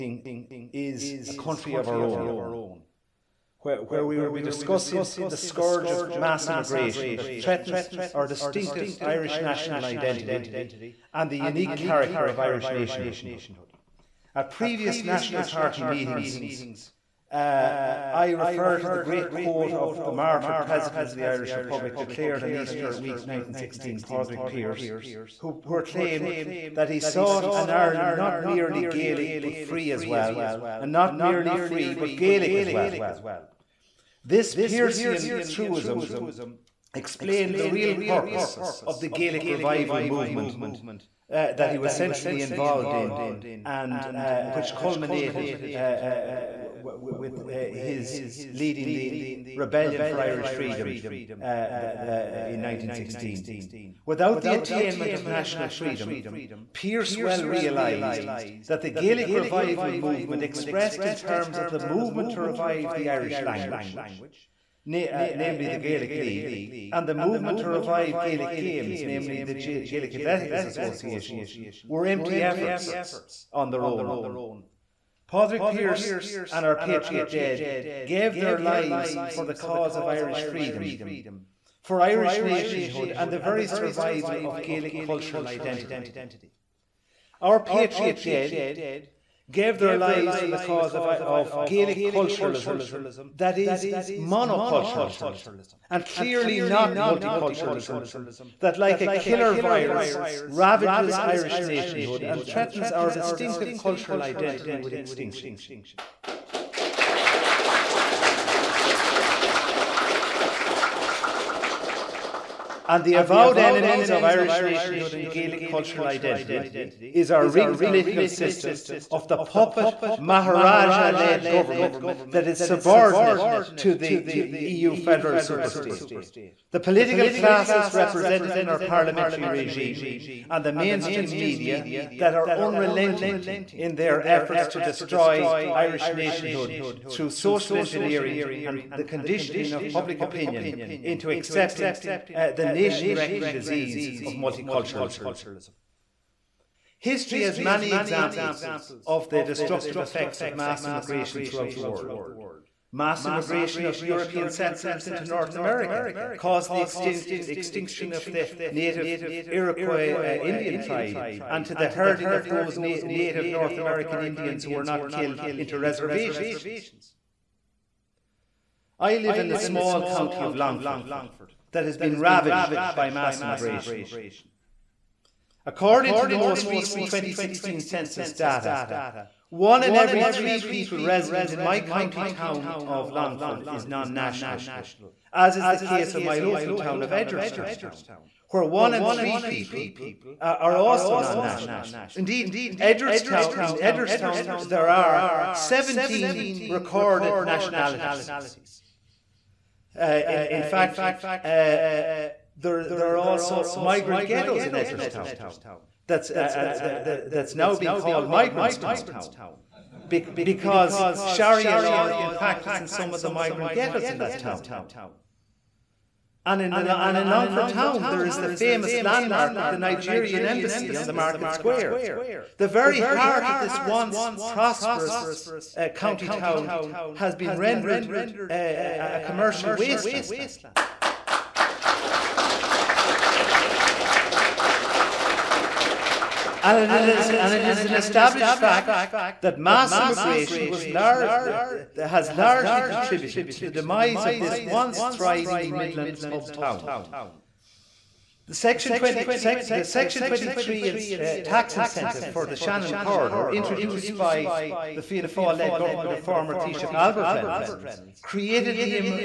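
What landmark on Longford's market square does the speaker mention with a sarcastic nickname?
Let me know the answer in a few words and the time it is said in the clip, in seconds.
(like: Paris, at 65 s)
Nigerian embassy, at 219 s.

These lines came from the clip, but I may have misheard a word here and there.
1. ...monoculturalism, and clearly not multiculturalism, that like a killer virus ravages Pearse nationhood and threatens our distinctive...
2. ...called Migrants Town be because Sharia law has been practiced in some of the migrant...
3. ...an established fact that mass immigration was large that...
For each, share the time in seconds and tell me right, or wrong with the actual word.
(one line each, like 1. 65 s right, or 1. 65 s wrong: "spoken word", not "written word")
1. 94 s wrong: "Irish", not "Pearse"
2. 207 s right
3. 237 s right.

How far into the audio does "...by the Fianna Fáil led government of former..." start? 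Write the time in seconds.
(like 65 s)
254 s.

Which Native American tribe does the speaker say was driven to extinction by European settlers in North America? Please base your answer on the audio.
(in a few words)
Iroquois.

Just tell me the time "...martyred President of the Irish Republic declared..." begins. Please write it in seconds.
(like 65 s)
20 s.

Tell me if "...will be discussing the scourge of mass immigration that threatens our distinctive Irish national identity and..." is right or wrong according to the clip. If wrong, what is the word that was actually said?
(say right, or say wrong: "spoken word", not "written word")
right.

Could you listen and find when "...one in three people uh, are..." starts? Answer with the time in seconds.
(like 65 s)
188 s.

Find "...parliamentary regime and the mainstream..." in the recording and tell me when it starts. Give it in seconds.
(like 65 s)
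128 s.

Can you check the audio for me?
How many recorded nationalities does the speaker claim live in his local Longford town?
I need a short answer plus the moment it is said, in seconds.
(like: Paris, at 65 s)
17, at 195 s.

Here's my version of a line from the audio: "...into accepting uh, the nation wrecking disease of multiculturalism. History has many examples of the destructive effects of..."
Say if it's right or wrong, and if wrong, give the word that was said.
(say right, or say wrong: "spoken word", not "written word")
right.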